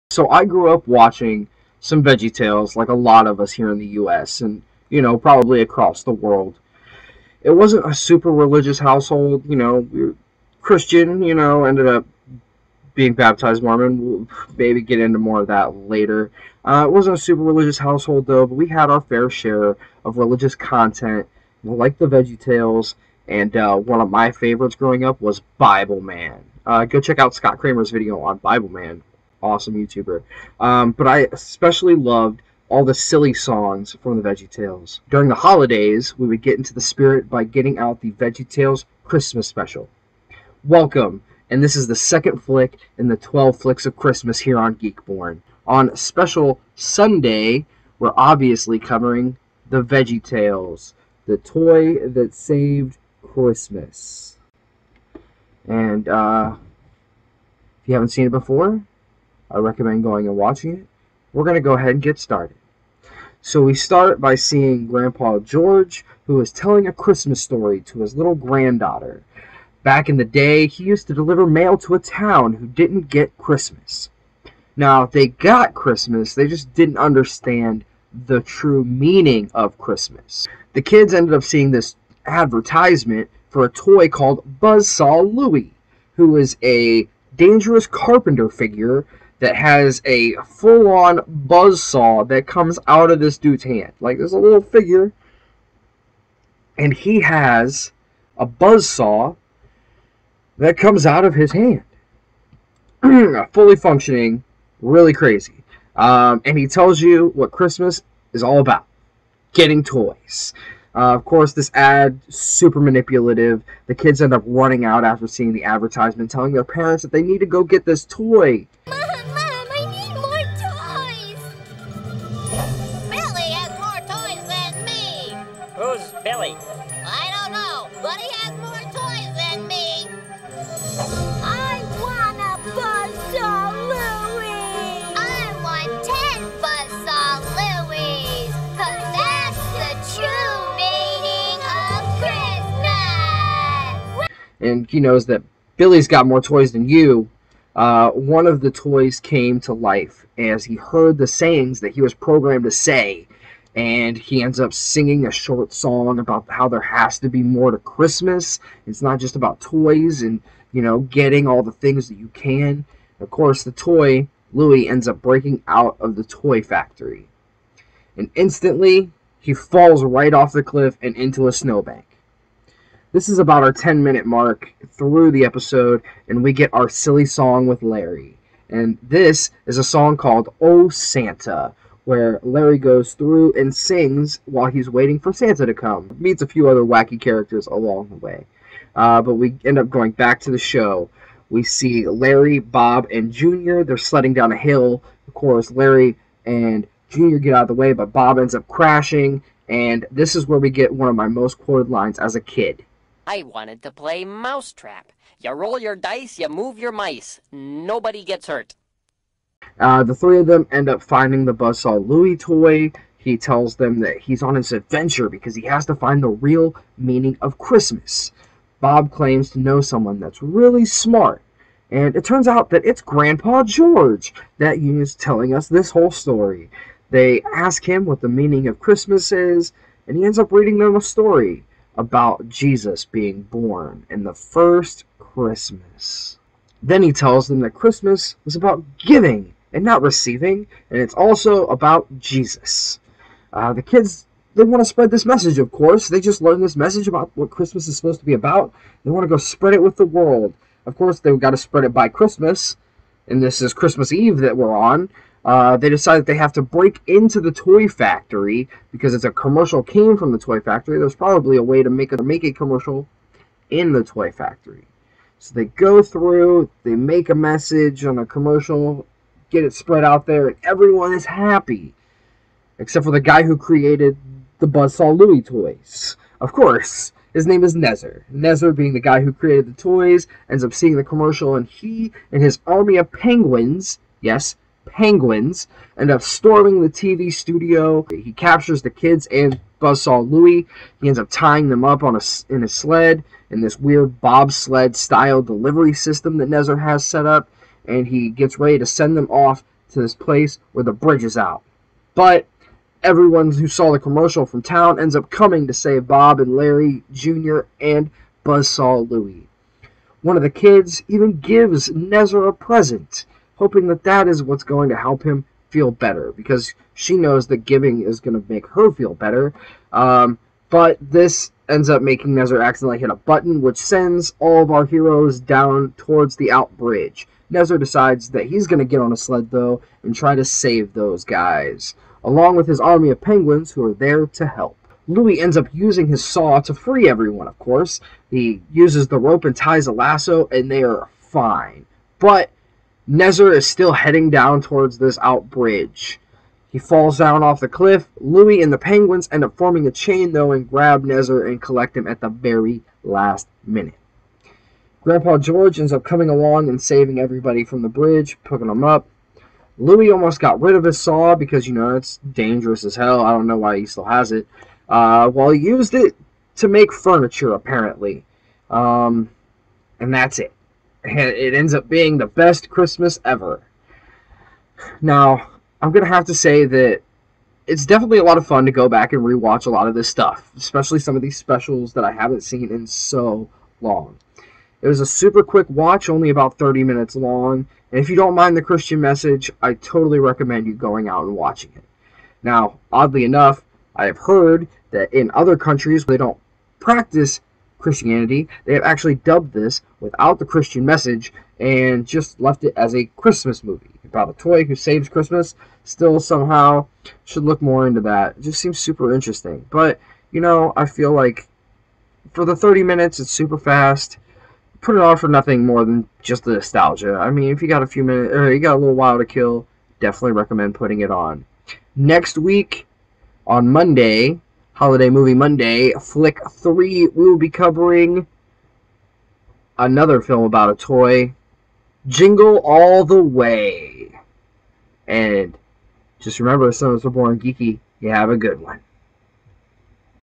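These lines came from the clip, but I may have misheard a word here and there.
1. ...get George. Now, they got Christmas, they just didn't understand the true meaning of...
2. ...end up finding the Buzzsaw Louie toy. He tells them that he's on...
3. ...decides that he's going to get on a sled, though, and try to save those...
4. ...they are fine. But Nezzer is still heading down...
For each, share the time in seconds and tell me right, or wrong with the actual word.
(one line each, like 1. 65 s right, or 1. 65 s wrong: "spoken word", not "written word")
1. 73 s wrong: "Christmas", not "George"
2. 210 s right
3. 327 s right
4. 340 s right.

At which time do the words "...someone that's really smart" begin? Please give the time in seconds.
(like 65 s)
219 s.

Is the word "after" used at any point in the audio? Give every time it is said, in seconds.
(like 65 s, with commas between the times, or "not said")
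115 s.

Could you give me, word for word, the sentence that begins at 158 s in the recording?
It's not just about toys and, you know, getting all the things that you can.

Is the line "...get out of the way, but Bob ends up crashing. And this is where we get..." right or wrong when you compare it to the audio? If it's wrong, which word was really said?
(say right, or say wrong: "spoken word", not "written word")
right.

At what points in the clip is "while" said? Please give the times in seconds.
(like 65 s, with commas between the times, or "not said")
184 s, 418 s.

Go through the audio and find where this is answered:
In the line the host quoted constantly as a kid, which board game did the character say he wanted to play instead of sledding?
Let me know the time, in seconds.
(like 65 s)
204 s.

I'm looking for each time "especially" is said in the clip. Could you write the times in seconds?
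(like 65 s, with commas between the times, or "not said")
31 s, 380 s.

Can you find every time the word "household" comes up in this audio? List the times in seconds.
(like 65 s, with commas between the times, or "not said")
8 s, 17 s.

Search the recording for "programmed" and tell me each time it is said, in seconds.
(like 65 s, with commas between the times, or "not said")
152 s.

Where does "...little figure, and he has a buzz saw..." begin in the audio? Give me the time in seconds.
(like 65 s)
94 s.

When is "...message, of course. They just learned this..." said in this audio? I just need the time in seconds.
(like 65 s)
245 s.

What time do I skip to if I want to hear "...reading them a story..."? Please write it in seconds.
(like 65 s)
230 s.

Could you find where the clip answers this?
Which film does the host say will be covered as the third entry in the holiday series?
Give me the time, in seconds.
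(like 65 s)
432 s.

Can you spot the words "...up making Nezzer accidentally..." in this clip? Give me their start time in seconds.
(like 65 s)
321 s.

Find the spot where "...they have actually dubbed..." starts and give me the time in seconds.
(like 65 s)
398 s.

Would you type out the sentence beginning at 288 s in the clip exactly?
He captures the kids and Buzzsaw Louie.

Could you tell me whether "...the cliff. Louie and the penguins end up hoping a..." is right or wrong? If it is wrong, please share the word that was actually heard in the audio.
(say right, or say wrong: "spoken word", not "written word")
wrong: "forming", not "hoping".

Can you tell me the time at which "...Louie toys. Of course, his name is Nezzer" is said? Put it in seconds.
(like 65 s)
275 s.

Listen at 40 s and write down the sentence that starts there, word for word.
Welcome, and this is the second flick in the 12 flicks of Christmas here on GeekBorne.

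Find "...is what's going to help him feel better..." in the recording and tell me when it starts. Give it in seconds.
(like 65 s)
314 s.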